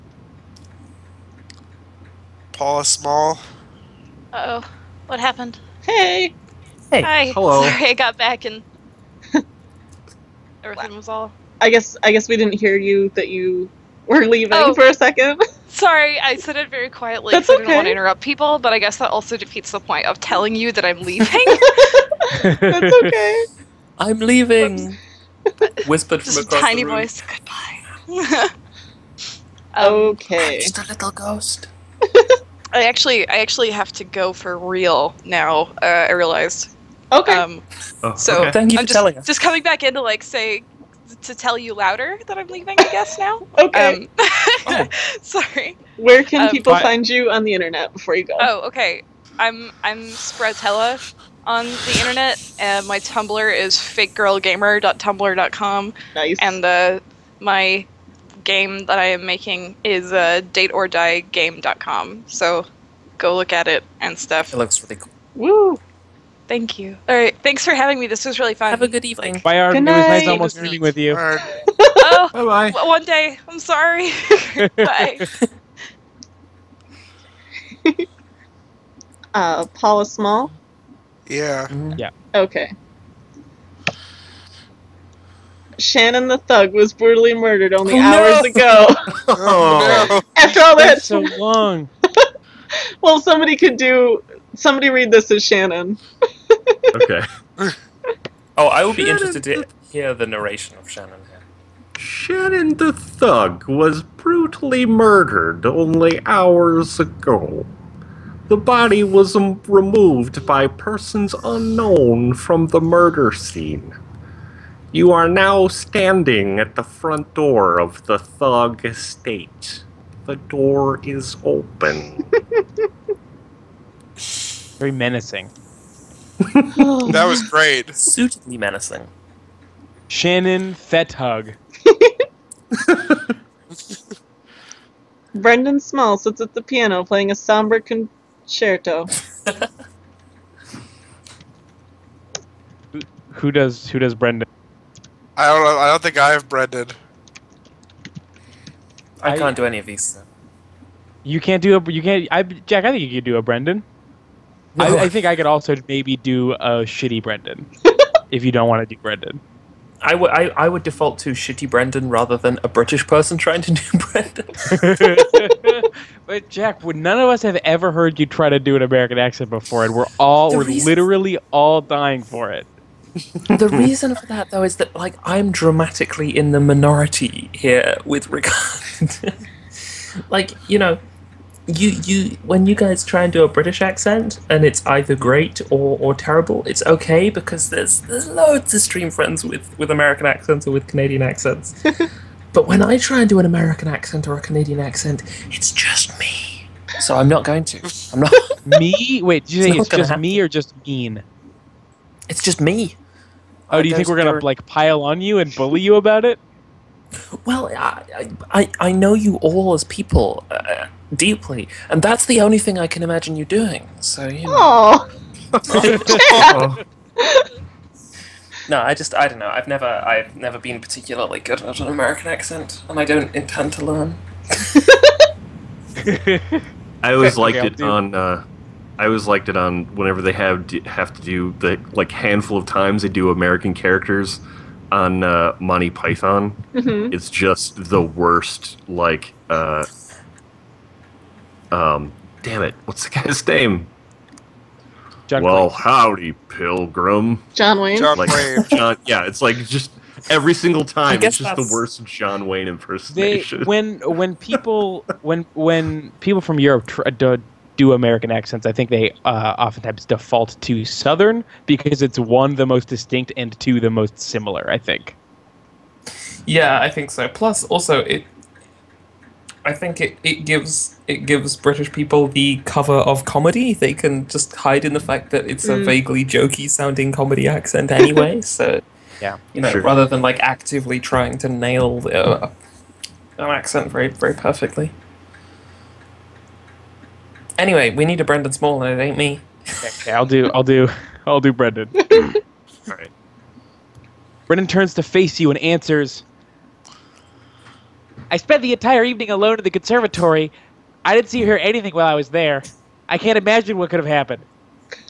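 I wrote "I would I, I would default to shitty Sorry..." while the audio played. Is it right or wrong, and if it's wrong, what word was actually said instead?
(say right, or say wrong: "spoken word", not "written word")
wrong: "Brendan", not "Sorry".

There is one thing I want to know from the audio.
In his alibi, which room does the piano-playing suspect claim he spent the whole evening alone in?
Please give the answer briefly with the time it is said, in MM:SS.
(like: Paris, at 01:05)
the conservatory, at 04:59.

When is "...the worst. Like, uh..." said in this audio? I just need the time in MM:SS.
03:57.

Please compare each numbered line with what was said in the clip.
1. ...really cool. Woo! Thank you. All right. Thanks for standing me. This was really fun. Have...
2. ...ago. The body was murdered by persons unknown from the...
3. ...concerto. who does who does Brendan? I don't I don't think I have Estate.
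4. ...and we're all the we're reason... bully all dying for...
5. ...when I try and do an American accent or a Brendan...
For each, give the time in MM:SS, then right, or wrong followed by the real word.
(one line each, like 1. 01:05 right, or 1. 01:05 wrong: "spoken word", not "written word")
1. 01:04 wrong: "having", not "standing"
2. 01:46 wrong: "removed", not "murdered"
3. 02:17 wrong: "Brendan", not "Estate"
4. 02:49 wrong: "literally", not "bully"
5. 03:12 wrong: "Canadian", not "Brendan".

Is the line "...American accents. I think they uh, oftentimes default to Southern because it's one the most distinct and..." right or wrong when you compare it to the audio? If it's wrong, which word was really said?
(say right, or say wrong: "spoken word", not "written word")
right.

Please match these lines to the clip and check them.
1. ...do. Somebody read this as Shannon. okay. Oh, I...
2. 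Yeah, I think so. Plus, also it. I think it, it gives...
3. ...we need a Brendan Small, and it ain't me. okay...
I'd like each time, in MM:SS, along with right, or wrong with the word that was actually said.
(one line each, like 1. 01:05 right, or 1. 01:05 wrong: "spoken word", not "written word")
1. 01:33 right
2. 04:26 right
3. 04:47 right.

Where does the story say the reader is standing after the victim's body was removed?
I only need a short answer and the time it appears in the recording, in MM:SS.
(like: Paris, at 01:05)
front door of the Thug Estate, at 01:56.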